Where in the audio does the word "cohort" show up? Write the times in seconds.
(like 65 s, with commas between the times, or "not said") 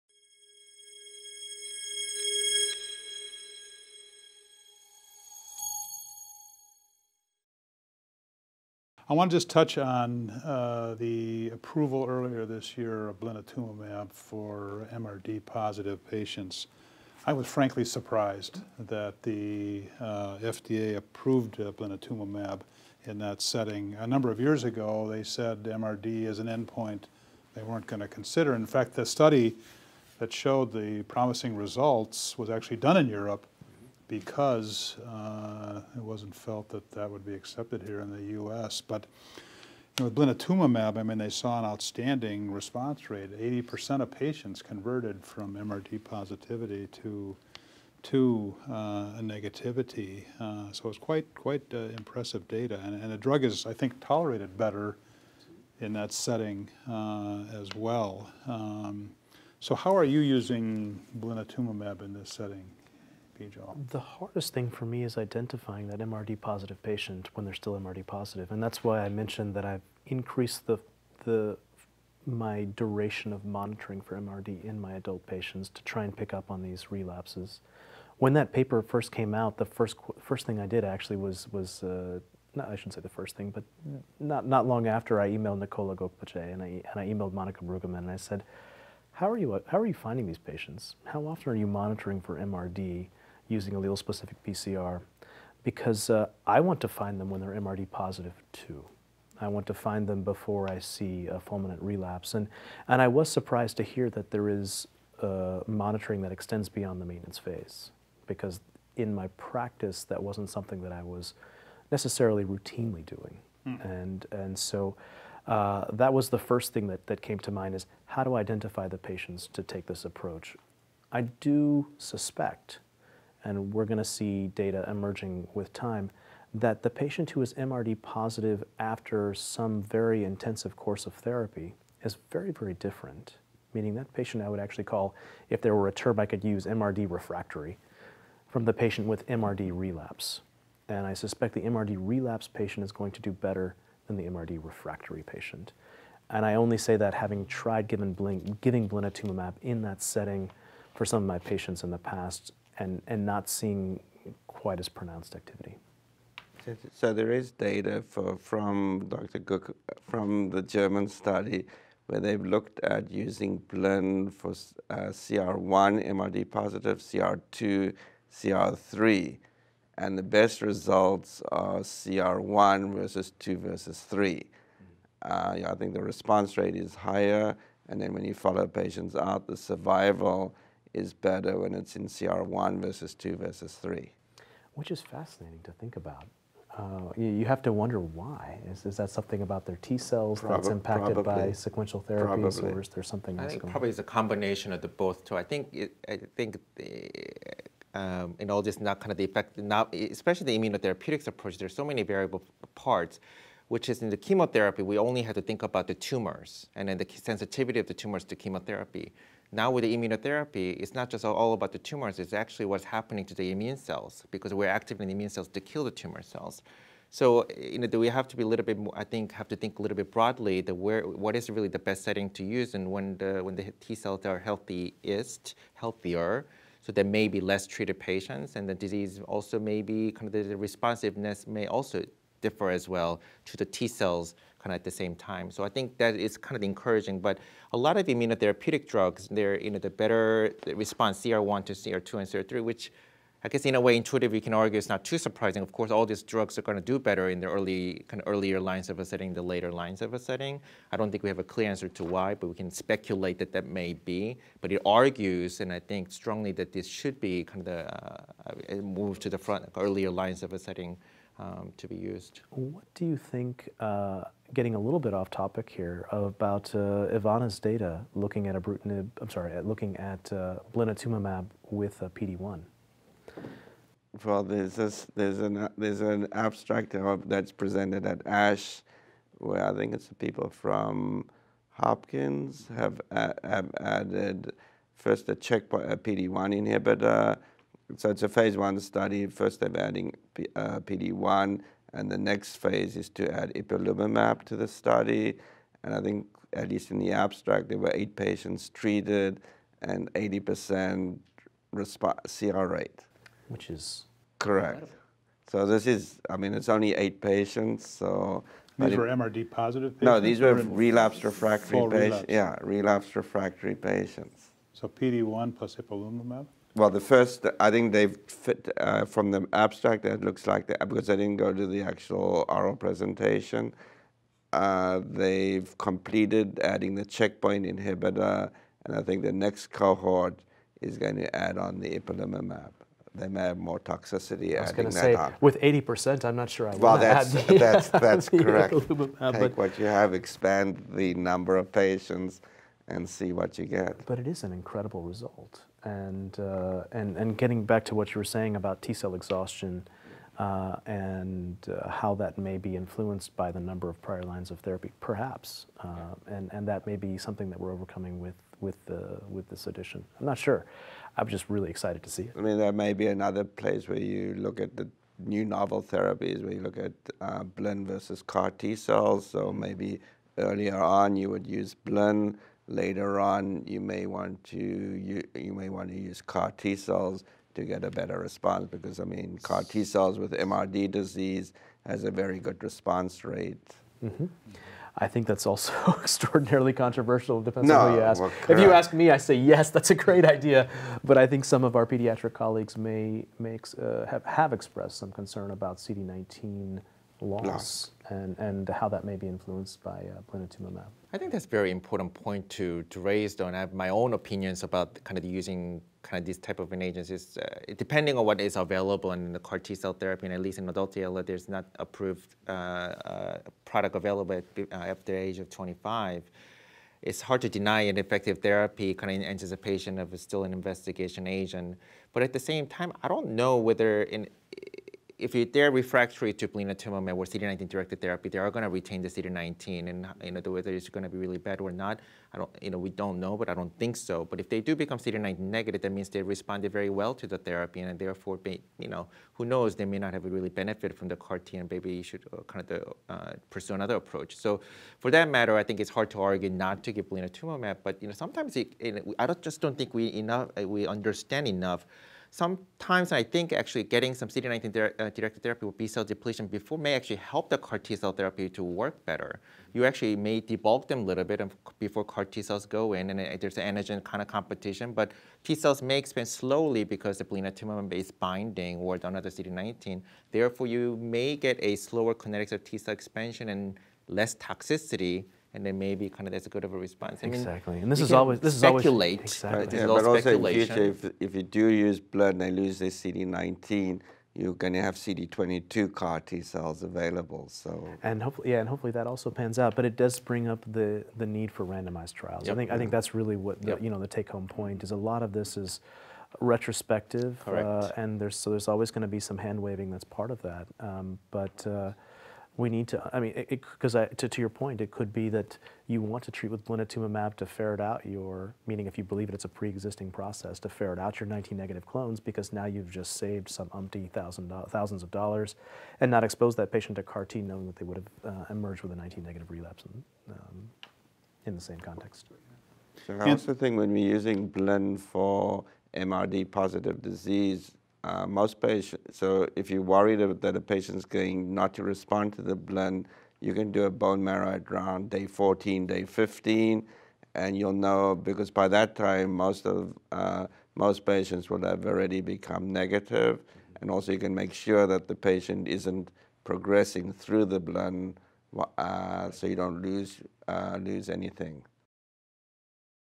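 329 s.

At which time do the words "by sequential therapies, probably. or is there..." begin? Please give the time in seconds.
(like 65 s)
191 s.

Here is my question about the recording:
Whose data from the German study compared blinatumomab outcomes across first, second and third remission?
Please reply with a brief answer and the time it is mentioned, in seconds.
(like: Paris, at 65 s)
Dr. Cook, at 159 s.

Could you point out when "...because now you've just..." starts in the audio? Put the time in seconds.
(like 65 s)
512 s.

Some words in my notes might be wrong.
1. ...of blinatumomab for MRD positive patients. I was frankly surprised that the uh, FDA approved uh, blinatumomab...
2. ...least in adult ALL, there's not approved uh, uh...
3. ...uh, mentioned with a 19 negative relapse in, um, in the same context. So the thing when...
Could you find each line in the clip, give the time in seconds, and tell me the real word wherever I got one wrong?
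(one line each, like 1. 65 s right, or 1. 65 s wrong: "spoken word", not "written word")
1. 13 s right
2. 410 s right
3. 518 s wrong: "emerged", not "mentioned".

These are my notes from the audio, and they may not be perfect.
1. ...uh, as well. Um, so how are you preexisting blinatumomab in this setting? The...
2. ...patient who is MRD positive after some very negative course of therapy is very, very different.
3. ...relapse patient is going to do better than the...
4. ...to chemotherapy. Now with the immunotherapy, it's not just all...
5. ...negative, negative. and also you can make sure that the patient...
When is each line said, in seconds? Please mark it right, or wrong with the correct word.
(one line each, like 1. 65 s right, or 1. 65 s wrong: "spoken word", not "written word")
1. 56 s wrong: "using", not "preexisting"
2. 126 s wrong: "intensive", not "negative"
3. 141 s right
4. 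208 s right
5. 542 s right.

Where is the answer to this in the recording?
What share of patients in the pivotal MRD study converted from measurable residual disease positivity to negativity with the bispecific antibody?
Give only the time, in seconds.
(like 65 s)
43 s.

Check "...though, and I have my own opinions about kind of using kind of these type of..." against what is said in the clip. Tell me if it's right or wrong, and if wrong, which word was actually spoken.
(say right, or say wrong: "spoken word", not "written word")
right.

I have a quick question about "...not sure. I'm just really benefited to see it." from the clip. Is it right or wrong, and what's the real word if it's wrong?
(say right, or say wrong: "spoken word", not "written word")
wrong: "excited", not "benefited".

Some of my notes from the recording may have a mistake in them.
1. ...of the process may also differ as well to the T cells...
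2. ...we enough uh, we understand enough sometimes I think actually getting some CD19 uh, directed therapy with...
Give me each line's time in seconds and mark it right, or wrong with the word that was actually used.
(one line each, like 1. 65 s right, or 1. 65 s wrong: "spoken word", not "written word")
1. 230 s wrong: "responsiveness", not "process"
2. 449 s right.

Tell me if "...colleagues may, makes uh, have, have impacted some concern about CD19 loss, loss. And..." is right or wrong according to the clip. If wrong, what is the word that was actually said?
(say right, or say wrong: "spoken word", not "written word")
wrong: "expressed", not "impacted".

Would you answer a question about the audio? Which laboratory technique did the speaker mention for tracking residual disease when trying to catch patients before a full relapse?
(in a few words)
allele-specific PCR.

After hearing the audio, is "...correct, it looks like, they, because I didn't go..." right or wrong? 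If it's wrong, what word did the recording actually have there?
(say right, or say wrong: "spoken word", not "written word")
wrong: "abstract", not "correct".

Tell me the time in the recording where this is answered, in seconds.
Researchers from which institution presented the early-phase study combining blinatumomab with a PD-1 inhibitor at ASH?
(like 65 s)
281 s.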